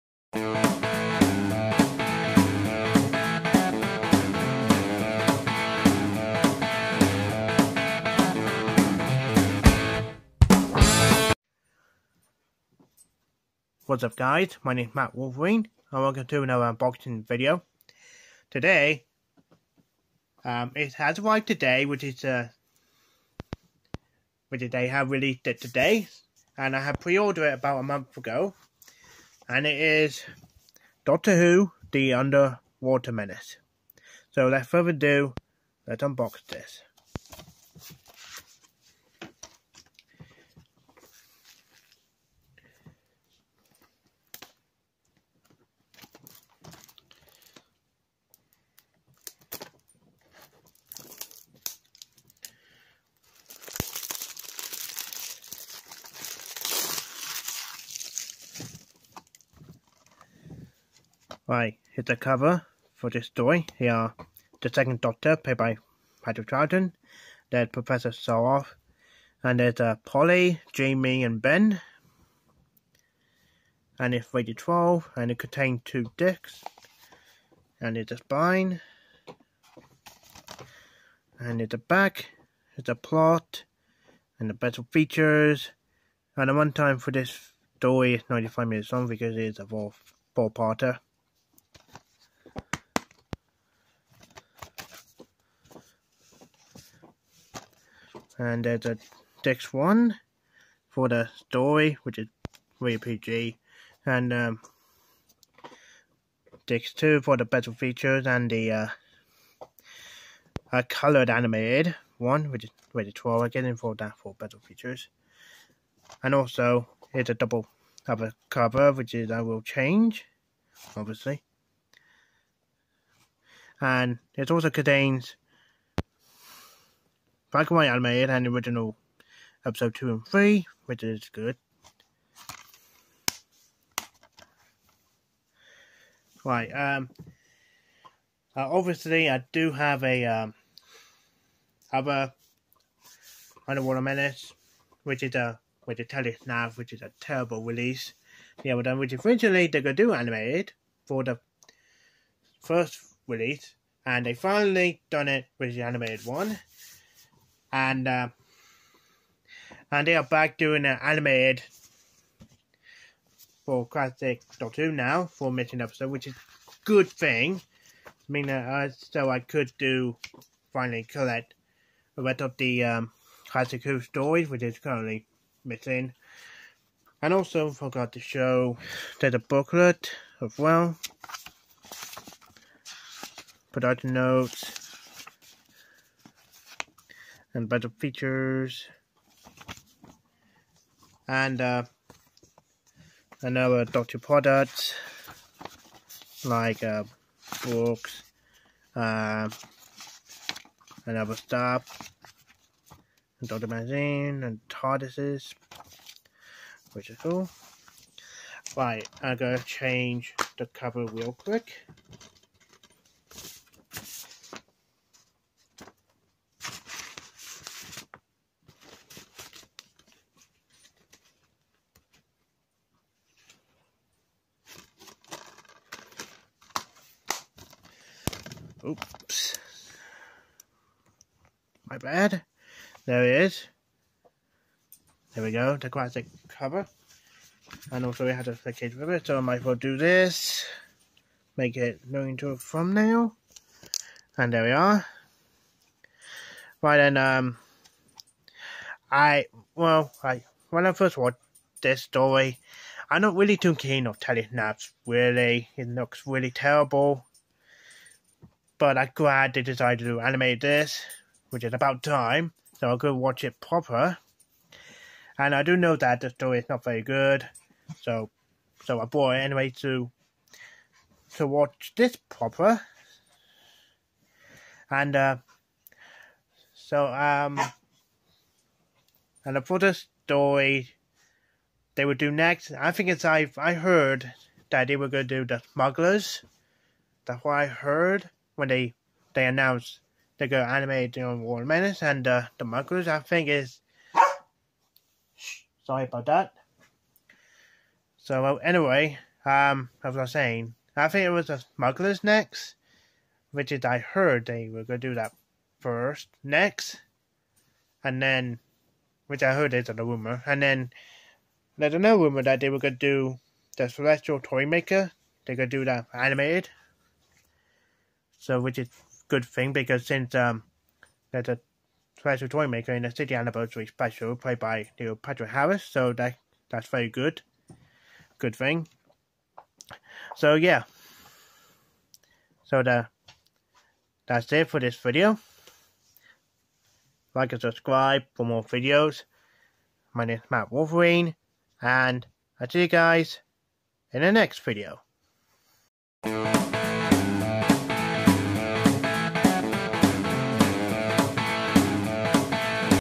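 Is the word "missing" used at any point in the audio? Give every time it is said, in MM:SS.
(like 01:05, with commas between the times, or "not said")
02:45, 02:55.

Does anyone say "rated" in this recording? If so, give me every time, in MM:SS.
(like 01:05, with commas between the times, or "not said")
01:14, 01:52.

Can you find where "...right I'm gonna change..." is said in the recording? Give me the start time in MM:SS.
03:28.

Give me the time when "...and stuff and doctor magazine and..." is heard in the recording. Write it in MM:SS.
03:21.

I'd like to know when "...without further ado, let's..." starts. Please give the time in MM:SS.
00:34.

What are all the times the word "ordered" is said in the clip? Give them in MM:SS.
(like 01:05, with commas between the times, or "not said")
00:27.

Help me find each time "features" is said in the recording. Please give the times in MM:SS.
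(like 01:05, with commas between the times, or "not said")
01:24, 01:47, 01:54, 03:07.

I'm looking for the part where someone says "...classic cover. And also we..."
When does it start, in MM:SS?
03:55.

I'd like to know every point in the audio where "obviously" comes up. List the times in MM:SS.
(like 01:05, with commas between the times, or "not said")
02:00, 02:18.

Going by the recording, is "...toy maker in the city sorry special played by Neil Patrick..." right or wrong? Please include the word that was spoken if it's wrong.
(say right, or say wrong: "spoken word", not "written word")
wrong: "anniversary", not "sorry".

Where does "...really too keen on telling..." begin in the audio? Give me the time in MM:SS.
04:13.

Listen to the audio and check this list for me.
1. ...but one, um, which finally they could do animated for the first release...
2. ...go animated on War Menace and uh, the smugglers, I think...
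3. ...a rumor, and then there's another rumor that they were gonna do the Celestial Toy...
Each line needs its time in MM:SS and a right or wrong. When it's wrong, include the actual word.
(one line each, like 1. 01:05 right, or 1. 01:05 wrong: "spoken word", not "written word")
1. 02:28 wrong: "originally", not "finally"
2. 04:50 right
3. 05:09 right.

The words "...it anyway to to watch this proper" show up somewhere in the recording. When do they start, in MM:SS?
04:29.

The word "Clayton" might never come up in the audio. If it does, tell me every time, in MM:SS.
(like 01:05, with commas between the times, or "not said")
not said.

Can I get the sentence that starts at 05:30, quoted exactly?
So yeah, so the that's it for this video.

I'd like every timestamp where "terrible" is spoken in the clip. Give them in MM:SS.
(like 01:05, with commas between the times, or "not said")
02:27, 04:16.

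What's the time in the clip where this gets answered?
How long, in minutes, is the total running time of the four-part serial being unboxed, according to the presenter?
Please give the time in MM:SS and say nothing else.
01:28.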